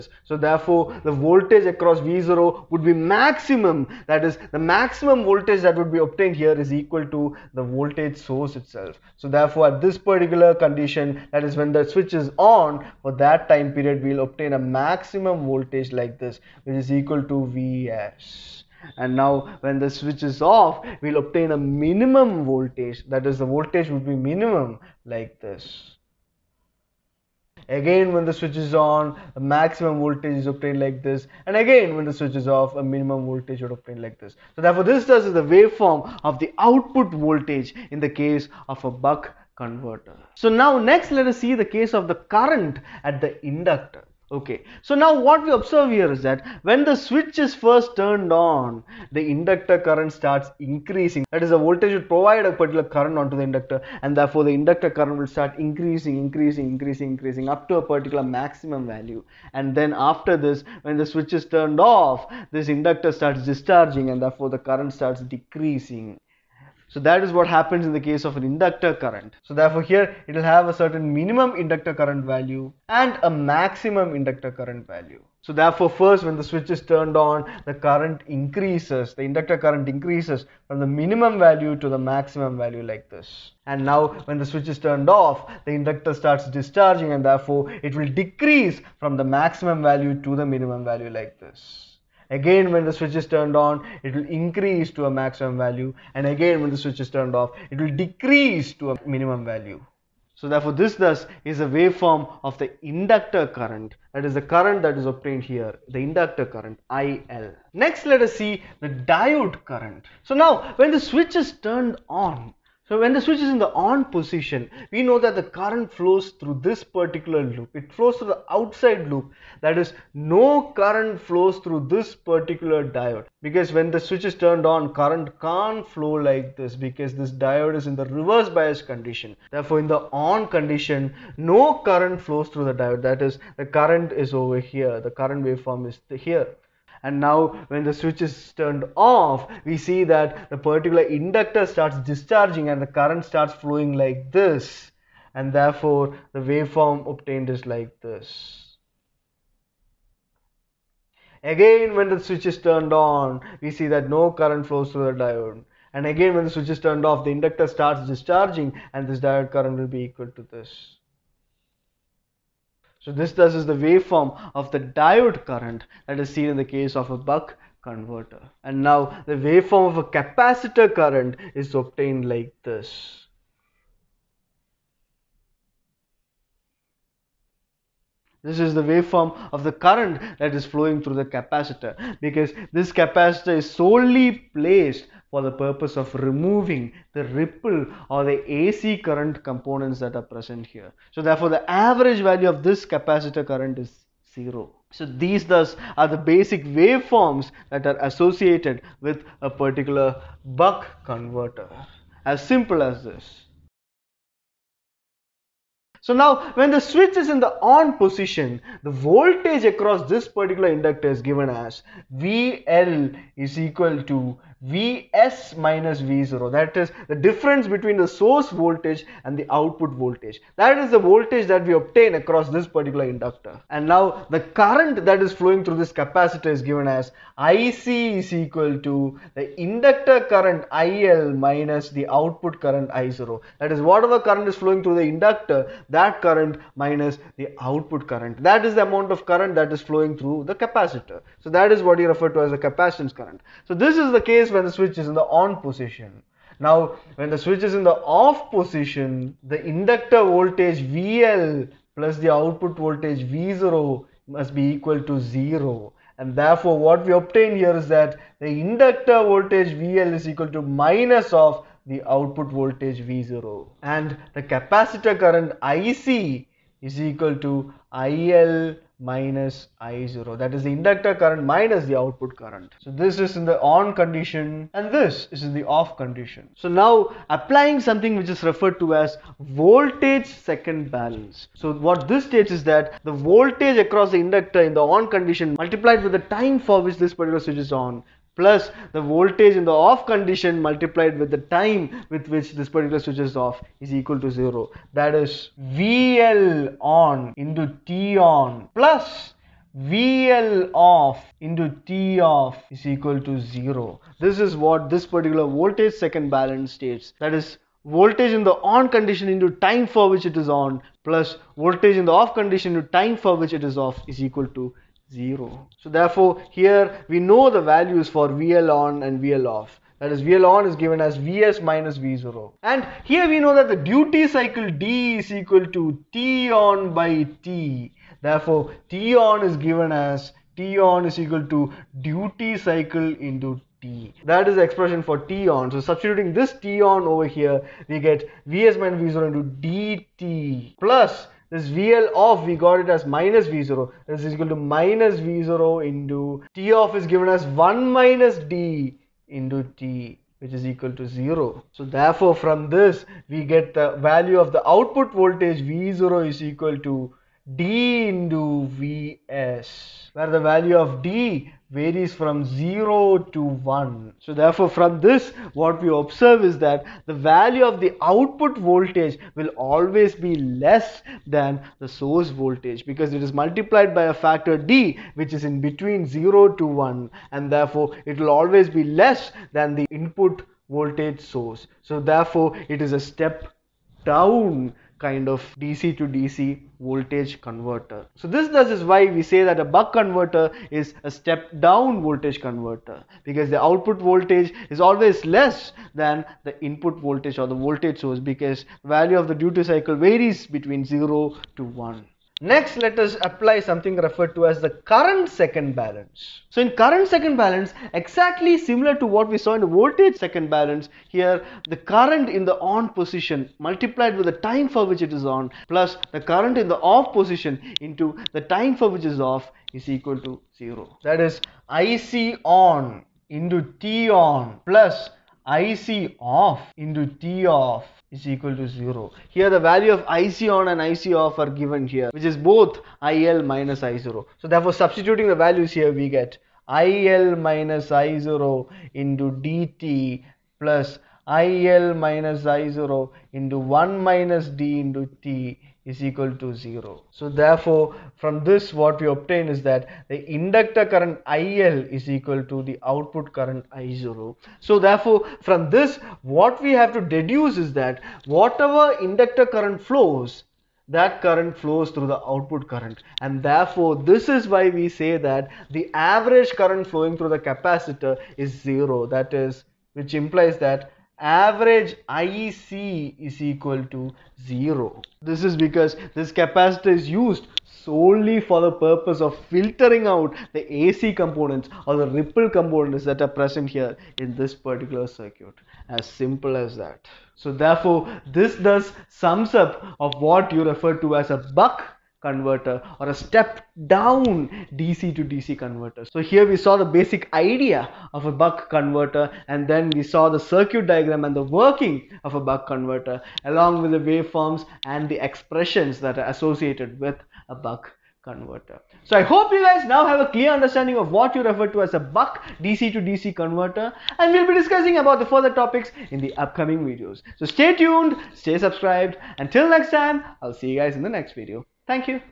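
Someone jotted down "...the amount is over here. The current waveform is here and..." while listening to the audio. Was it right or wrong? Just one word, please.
wrong.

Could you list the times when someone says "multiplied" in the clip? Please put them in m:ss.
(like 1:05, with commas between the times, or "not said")
4:45, 4:50, 6:13, 6:53.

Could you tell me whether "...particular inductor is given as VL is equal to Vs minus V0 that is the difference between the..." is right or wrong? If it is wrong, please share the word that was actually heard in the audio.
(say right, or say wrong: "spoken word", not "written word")
right.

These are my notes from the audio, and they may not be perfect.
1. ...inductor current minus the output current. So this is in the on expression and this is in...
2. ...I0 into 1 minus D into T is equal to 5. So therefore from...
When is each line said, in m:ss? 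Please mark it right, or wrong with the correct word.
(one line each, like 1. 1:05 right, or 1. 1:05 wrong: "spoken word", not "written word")
1. 4:30 wrong: "condition", not "expression"
2. 7:22 wrong: "0", not "5".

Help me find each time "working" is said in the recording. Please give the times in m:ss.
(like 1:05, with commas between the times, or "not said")
8:21.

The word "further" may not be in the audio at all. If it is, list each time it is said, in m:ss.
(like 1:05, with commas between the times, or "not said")
8:35.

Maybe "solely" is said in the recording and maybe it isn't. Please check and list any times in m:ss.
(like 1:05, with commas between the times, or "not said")
3:03, 7:57.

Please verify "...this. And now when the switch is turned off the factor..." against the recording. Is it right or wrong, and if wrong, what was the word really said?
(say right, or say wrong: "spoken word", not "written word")
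wrong: "inductor", not "factor".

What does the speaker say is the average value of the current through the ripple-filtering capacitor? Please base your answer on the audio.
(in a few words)
0.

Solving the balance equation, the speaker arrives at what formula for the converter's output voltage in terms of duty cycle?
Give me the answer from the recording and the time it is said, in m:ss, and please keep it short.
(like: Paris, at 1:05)
V0 = D × Vs, at 5:55.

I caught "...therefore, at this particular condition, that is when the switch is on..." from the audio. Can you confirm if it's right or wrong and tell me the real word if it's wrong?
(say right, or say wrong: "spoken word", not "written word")
right.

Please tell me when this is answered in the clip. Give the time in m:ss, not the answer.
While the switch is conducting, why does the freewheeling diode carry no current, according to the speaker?
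2:08.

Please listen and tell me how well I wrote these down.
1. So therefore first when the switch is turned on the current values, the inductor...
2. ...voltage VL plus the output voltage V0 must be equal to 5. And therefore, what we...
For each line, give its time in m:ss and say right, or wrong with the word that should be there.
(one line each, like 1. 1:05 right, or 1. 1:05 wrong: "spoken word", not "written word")
1. 1:15 wrong: "increases", not "values"
2. 4:10 wrong: "0", not "5".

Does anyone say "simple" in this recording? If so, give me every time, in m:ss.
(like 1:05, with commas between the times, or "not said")
3:22, 8:06.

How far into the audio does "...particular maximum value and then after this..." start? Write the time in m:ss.
0:57.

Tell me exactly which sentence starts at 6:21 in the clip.
So therefore it is a step down kind of DC to DC voltage converter.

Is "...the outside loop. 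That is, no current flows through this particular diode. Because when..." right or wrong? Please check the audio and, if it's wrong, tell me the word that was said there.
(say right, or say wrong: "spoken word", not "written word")
right.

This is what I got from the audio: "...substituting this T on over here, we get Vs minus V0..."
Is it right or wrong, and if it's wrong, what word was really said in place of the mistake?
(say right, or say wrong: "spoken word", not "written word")
right.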